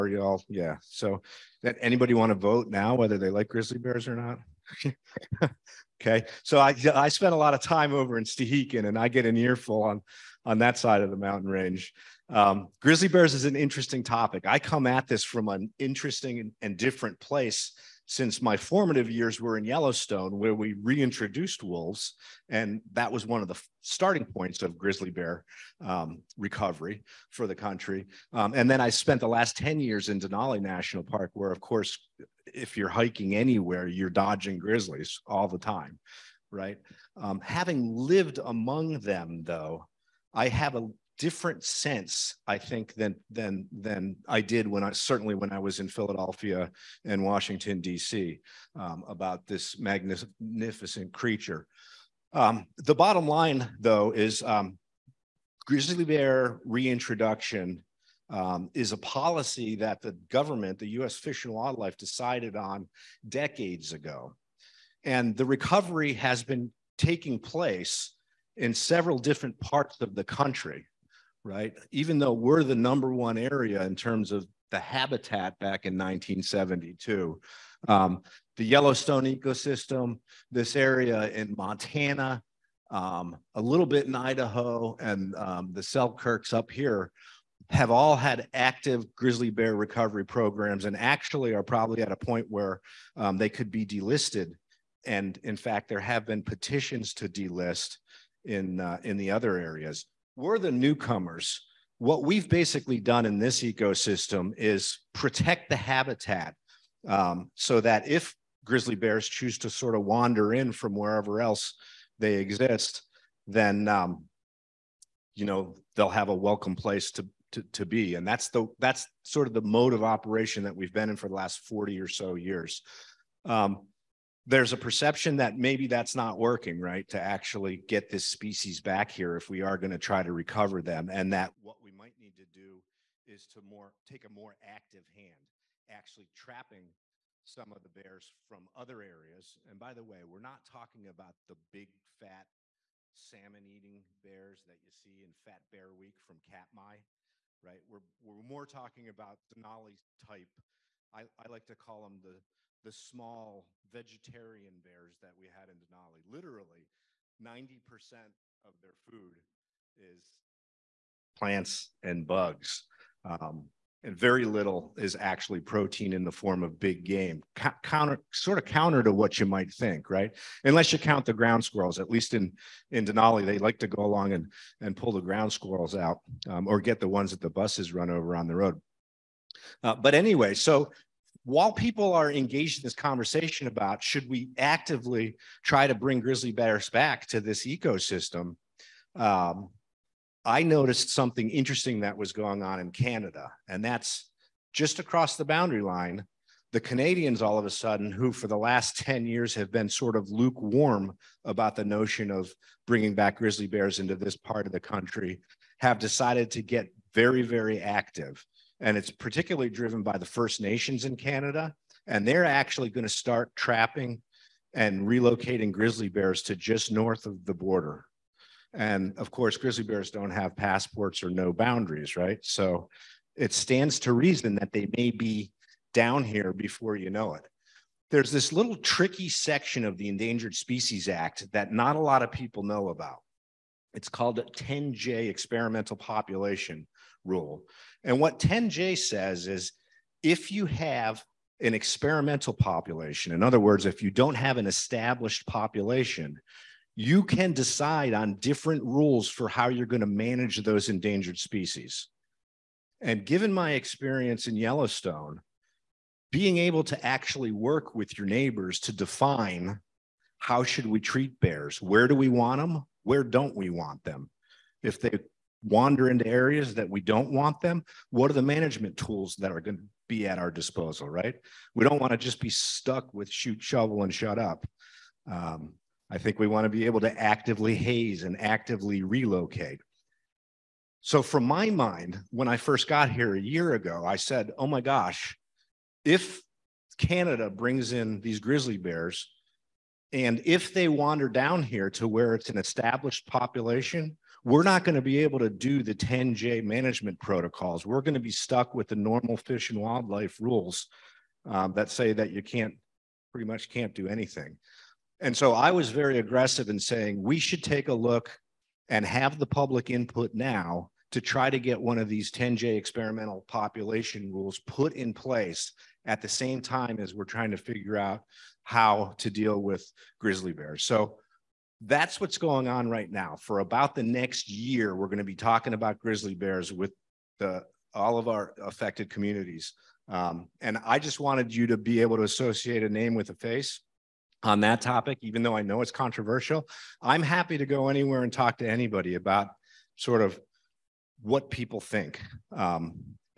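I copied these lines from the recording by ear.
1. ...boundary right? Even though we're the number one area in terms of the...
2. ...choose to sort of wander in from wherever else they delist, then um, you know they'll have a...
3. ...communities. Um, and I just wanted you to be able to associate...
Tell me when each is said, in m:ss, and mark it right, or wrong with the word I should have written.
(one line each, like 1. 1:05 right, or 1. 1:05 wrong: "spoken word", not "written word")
1. 1:10 wrong: "country", not "boundary"
2. 1:49 wrong: "exist", not "delist"
3. 5:29 right.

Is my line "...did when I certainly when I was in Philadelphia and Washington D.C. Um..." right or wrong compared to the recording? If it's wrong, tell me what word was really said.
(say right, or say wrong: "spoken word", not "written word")
right.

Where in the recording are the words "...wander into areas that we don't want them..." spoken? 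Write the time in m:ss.
4:25.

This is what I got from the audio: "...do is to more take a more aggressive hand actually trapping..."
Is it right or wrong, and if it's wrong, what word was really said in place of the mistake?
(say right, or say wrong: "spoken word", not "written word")
wrong: "active", not "aggressive".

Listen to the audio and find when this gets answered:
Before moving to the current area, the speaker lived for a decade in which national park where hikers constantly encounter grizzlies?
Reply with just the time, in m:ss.
0:30.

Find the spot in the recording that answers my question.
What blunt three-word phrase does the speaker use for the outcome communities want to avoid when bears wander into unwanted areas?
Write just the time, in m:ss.
4:33.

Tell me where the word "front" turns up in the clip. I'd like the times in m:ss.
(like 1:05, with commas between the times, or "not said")
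not said.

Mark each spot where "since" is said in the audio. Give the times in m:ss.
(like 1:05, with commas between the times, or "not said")
0:18.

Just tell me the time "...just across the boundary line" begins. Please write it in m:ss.
3:14.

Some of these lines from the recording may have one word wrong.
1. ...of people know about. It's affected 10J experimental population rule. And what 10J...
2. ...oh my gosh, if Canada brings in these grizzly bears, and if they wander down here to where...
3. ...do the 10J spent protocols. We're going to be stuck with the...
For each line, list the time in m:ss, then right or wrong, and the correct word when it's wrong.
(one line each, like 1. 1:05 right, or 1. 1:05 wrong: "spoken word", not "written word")
1. 3:52 wrong: "called", not "affected"
2. 4:44 right
3. 4:55 wrong: "management", not "spent".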